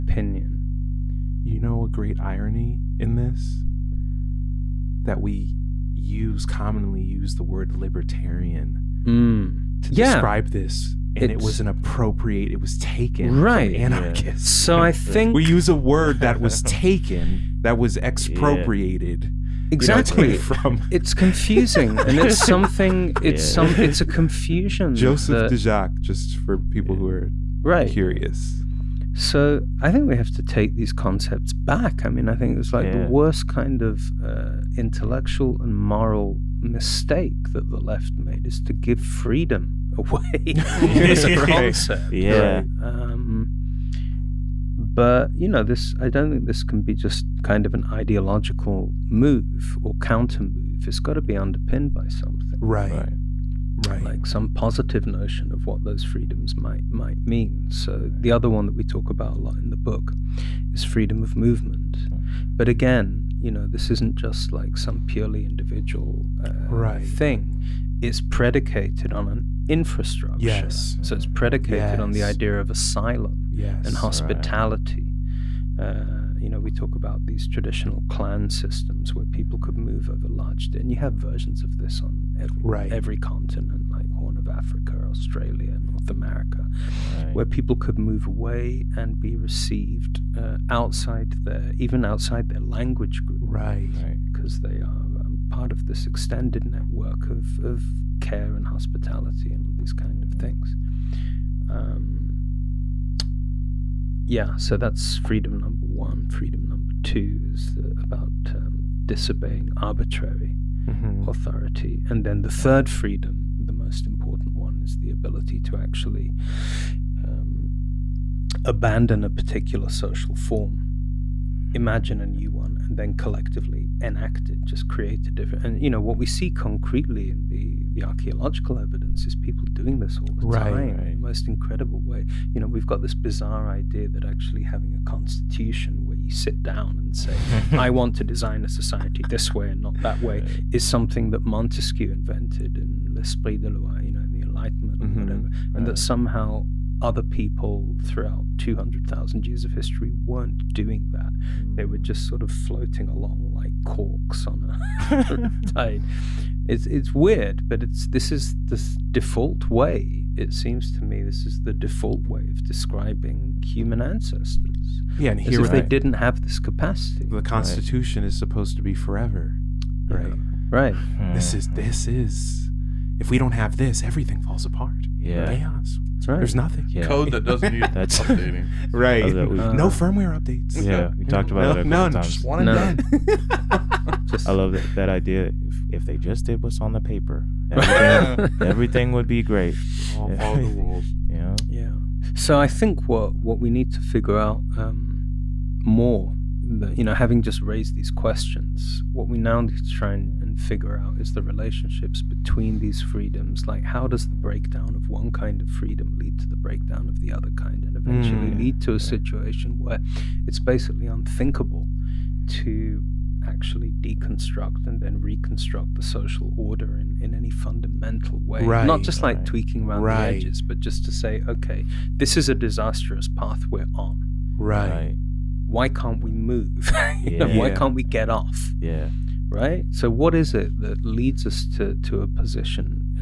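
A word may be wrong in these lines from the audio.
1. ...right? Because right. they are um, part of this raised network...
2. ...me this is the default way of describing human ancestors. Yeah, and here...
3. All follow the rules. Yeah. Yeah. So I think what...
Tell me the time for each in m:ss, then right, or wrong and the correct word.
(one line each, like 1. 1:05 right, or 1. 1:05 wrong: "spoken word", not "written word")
1. 1:33 wrong: "extended", not "raised"
2. 2:41 right
3. 3:10 right.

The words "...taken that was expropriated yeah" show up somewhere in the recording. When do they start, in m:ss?
0:16.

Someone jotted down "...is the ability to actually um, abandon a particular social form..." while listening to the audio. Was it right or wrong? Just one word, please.
right.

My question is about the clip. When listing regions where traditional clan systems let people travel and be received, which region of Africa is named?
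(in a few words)
Horn of Africa.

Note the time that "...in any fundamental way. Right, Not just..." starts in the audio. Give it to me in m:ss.
3:37.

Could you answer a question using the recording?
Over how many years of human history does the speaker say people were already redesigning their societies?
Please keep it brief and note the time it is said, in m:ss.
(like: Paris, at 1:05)
200,000, at 2:28.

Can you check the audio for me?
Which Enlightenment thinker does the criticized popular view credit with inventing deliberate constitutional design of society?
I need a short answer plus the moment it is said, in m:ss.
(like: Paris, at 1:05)
Montesquieu, at 2:21.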